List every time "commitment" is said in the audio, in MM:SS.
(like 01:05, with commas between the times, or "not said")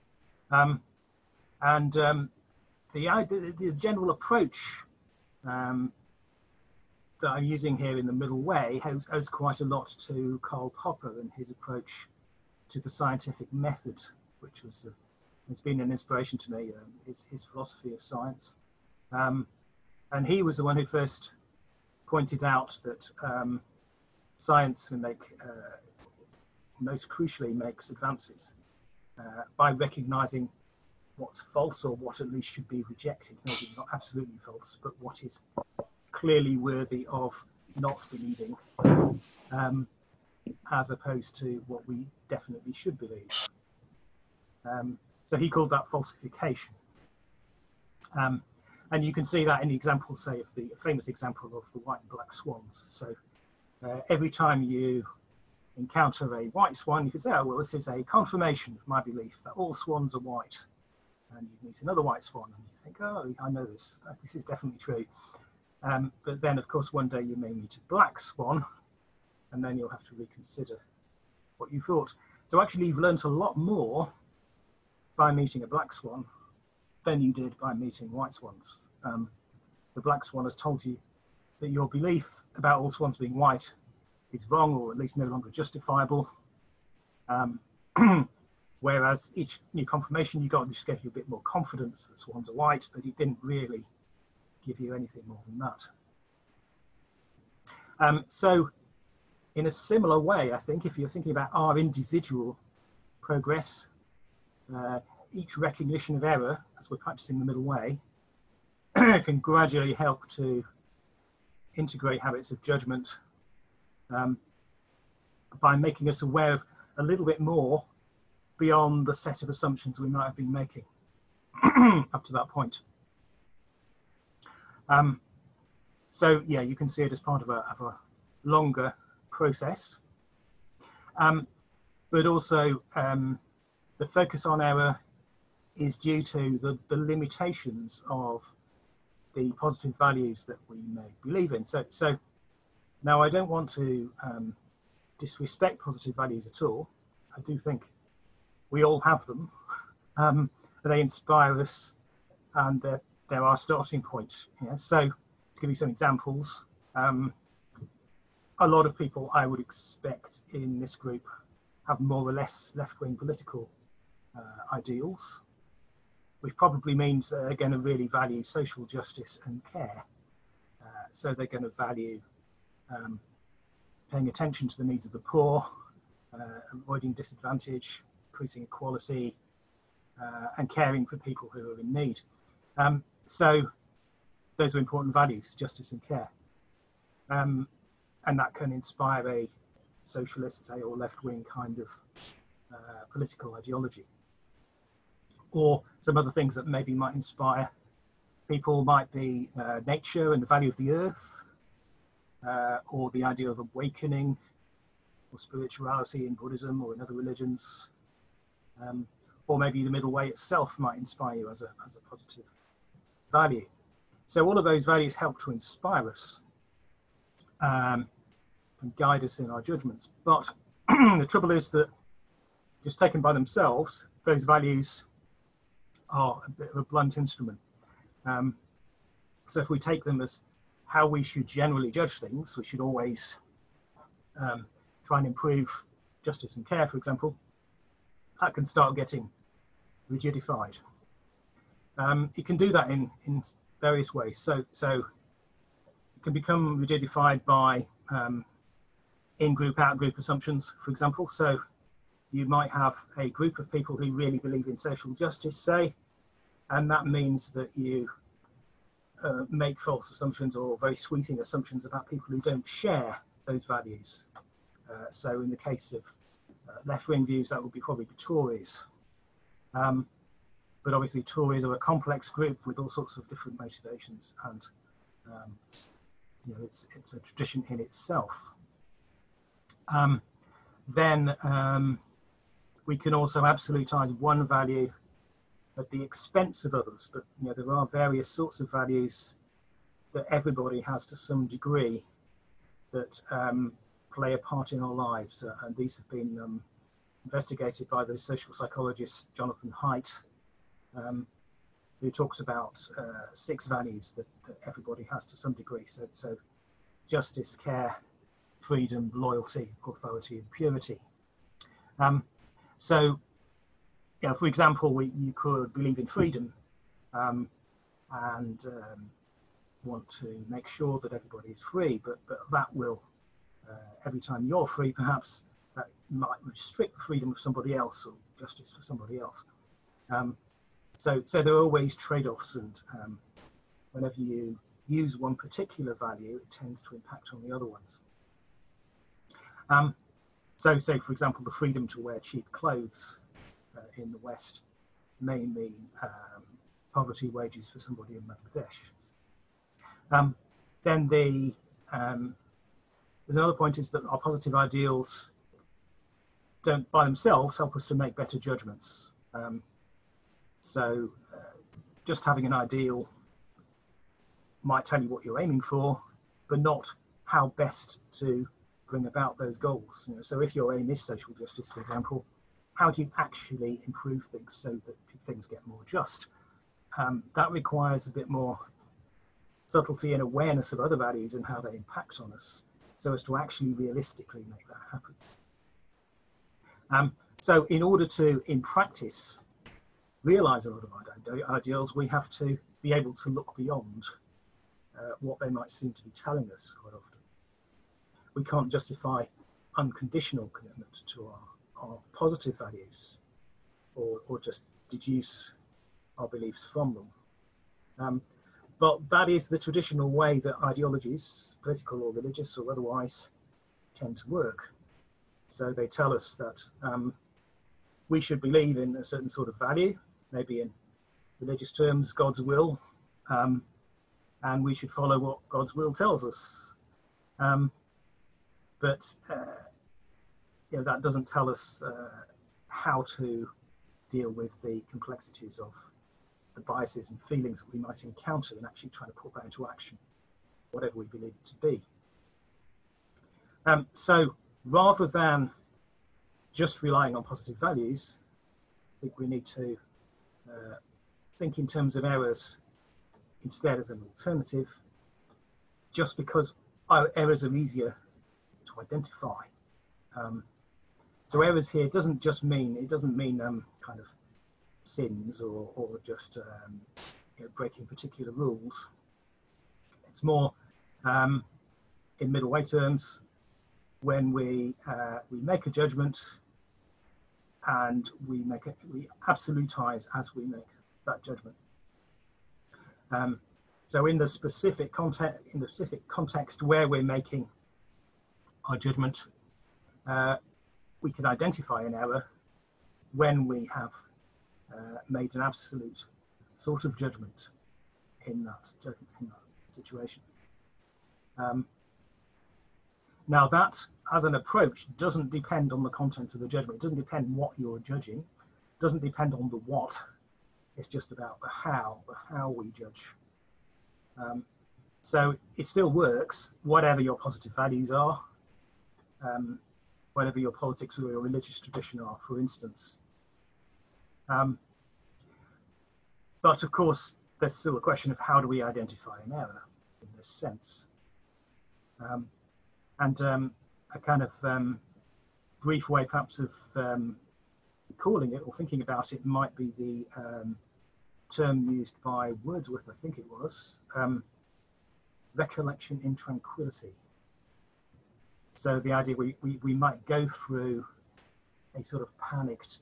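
06:40.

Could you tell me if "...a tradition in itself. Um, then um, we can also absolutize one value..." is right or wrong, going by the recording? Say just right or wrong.
right.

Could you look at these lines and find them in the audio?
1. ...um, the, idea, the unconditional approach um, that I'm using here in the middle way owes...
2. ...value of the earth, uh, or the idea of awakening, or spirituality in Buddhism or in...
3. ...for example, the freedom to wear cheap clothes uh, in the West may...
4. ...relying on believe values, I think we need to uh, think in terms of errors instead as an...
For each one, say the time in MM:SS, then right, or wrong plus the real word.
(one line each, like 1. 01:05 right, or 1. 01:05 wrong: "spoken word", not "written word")
1. 00:01 wrong: "general", not "unconditional"
2. 03:20 right
3. 05:40 right
4. 07:26 wrong: "positive", not "believe".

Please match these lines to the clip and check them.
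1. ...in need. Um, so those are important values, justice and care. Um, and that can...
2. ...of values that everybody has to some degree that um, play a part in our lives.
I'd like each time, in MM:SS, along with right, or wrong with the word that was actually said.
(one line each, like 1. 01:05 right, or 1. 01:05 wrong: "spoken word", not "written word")
1. 03:01 right
2. 04:48 right.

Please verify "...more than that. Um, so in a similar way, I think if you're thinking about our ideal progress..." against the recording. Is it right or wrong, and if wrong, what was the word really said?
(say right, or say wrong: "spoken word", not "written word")
wrong: "individual", not "ideal".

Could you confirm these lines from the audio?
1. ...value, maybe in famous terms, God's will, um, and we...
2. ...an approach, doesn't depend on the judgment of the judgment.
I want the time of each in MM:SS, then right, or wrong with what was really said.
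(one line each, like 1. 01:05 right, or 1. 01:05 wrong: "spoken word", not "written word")
1. 06:59 wrong: "religious", not "famous"
2. 08:24 wrong: "content", not "judgment".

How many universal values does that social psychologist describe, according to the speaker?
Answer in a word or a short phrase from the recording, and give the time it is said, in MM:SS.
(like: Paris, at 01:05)
6, at 05:03.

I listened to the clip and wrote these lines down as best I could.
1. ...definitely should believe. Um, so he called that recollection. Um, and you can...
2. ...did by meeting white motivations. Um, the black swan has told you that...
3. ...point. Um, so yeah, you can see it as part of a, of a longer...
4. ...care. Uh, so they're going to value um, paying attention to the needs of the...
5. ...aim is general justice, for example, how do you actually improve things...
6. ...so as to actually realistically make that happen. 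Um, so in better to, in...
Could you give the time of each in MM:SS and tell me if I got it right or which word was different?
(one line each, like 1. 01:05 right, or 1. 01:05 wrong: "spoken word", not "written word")
1. 00:42 wrong: "falsification", not "recollection"
2. 01:17 wrong: "swans", not "motivations"
3. 02:02 right
4. 02:49 right
5. 06:10 wrong: "social", not "general"
6. 06:22 wrong: "order", not "better".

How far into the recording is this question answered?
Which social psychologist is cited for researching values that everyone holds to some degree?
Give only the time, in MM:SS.
04:59.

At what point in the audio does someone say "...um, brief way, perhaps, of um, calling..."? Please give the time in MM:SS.
08:54.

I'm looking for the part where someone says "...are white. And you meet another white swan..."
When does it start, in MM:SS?
01:00.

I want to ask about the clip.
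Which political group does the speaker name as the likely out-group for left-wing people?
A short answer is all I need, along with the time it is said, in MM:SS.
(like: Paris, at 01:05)
the Tories, at 04:28.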